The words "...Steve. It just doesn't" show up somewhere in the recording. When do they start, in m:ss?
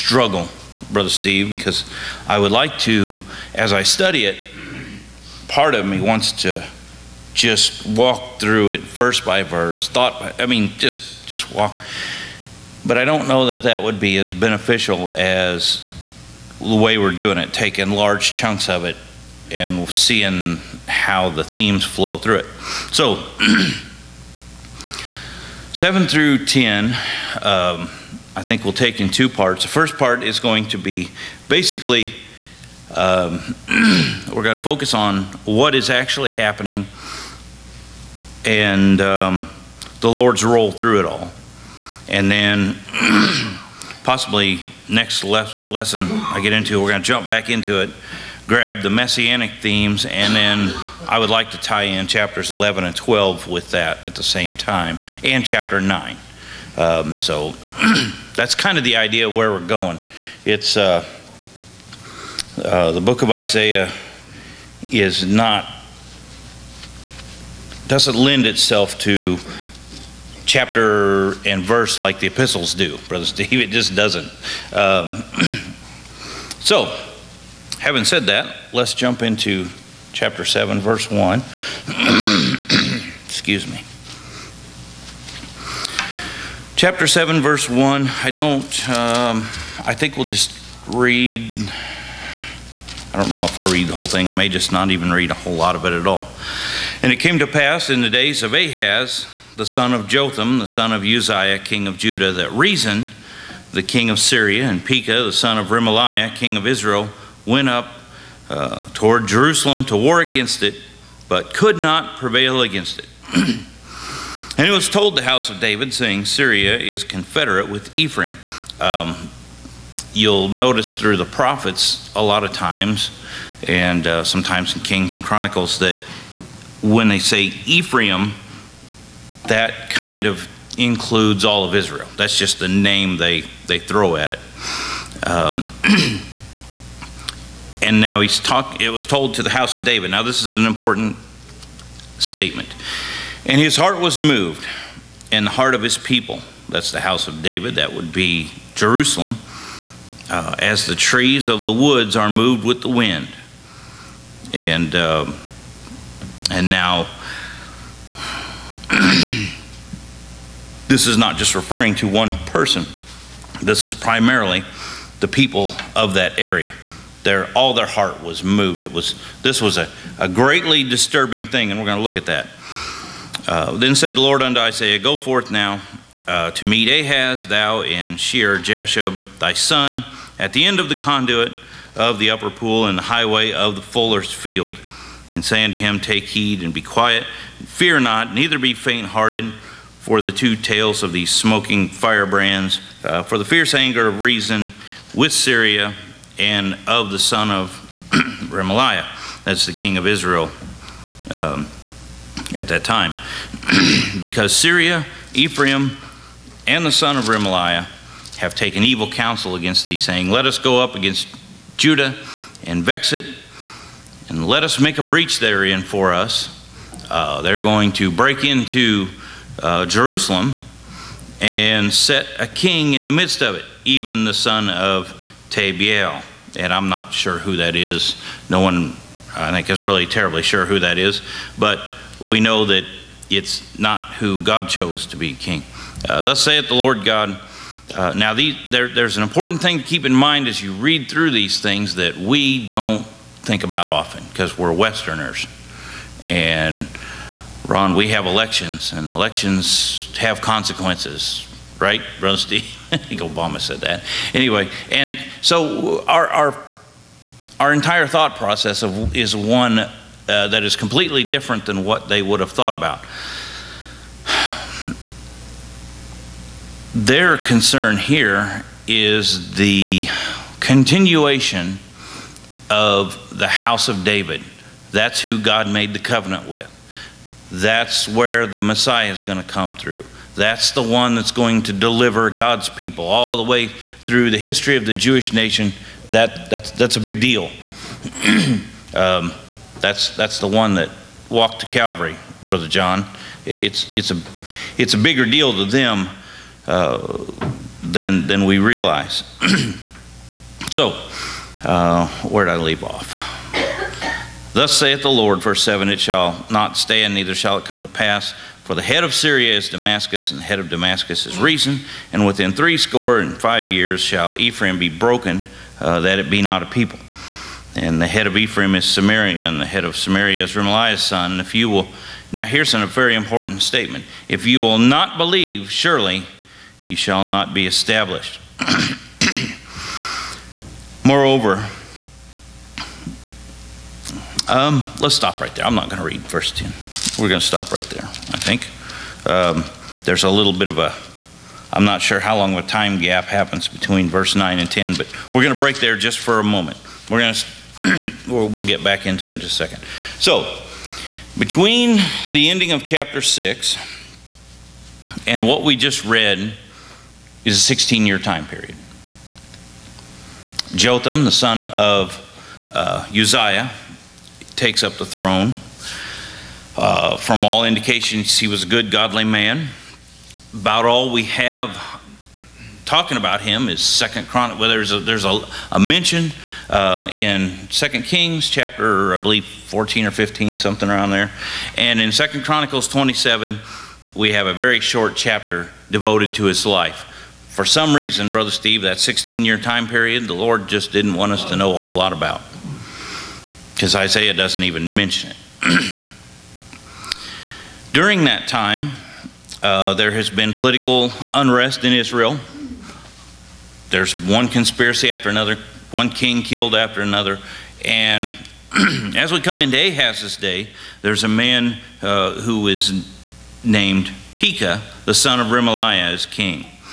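1:13.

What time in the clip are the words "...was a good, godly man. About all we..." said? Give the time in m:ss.
6:08.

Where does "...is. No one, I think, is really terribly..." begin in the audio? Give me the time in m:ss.
3:47.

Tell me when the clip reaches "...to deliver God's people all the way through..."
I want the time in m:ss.
4:41.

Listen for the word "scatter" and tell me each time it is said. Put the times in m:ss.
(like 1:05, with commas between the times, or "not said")
not said.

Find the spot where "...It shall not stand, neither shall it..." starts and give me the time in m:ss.
5:05.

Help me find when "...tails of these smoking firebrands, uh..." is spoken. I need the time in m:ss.
3:10.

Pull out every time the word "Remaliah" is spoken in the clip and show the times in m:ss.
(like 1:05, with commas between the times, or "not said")
1:45, 3:18, 3:27, 5:20, 6:55.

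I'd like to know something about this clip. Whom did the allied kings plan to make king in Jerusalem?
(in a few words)
the son of Tabiel.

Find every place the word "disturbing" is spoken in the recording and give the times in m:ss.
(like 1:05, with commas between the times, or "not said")
2:50.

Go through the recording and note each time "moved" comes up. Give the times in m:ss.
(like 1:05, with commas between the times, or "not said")
2:24, 2:32, 2:48.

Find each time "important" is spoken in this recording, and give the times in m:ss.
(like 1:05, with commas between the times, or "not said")
2:20, 3:59, 5:23.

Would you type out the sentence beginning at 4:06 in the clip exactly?
And Ron, we have elections, and elections have consequences, right, Brother Steve?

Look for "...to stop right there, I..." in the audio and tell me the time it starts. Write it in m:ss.
5:37.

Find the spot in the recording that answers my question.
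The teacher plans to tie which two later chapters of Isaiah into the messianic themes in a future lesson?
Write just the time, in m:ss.
0:52.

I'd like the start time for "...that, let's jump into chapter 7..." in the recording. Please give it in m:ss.
1:18.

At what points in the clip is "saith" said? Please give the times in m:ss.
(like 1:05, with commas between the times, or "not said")
3:56, 5:04.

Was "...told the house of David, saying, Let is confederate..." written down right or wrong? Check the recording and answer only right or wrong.
wrong.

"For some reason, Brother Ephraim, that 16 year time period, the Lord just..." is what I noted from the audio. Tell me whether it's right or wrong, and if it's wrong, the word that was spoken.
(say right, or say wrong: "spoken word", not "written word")
wrong: "Steve", not "Ephraim".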